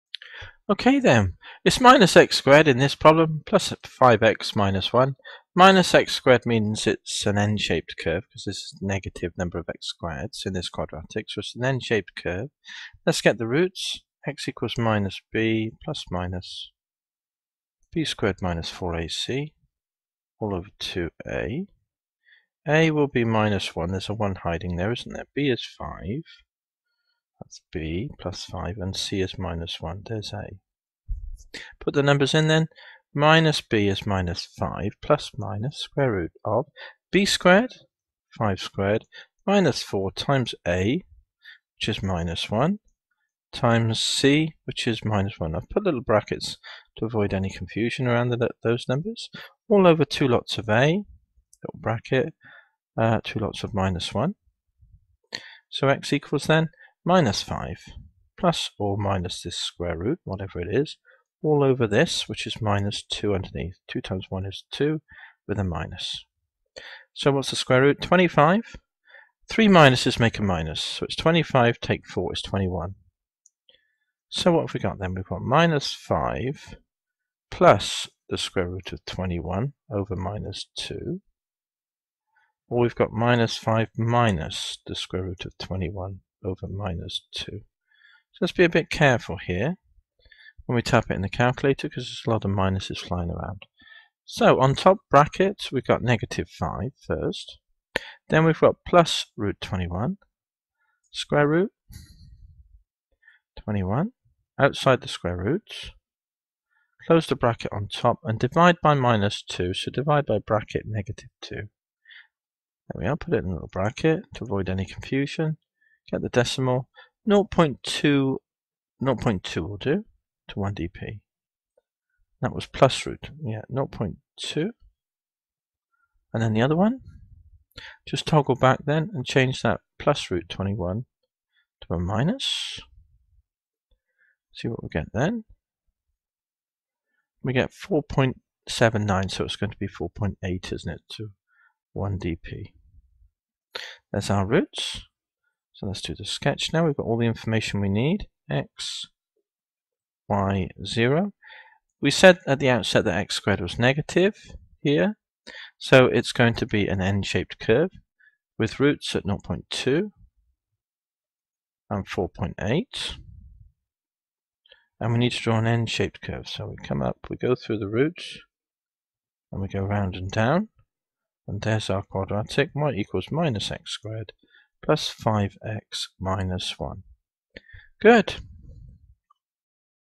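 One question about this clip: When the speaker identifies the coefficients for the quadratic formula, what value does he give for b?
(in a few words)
5.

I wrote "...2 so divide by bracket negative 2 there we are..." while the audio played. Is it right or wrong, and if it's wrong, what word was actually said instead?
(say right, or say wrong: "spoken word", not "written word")
right.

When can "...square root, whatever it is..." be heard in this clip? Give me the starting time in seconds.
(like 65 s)
59 s.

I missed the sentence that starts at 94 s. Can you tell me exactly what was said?
So on top bracket we've got negative 5 first.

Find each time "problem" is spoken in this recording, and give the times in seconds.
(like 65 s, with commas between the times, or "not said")
2 s.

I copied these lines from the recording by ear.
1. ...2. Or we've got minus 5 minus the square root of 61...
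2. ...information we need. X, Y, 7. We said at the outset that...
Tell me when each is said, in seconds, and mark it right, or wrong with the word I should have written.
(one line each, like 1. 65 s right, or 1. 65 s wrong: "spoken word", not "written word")
1. 80 s wrong: "21", not "61"
2. 147 s wrong: "0", not "7".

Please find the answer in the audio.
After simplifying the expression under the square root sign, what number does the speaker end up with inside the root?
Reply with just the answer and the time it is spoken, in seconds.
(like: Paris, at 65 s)
21, at 71 s.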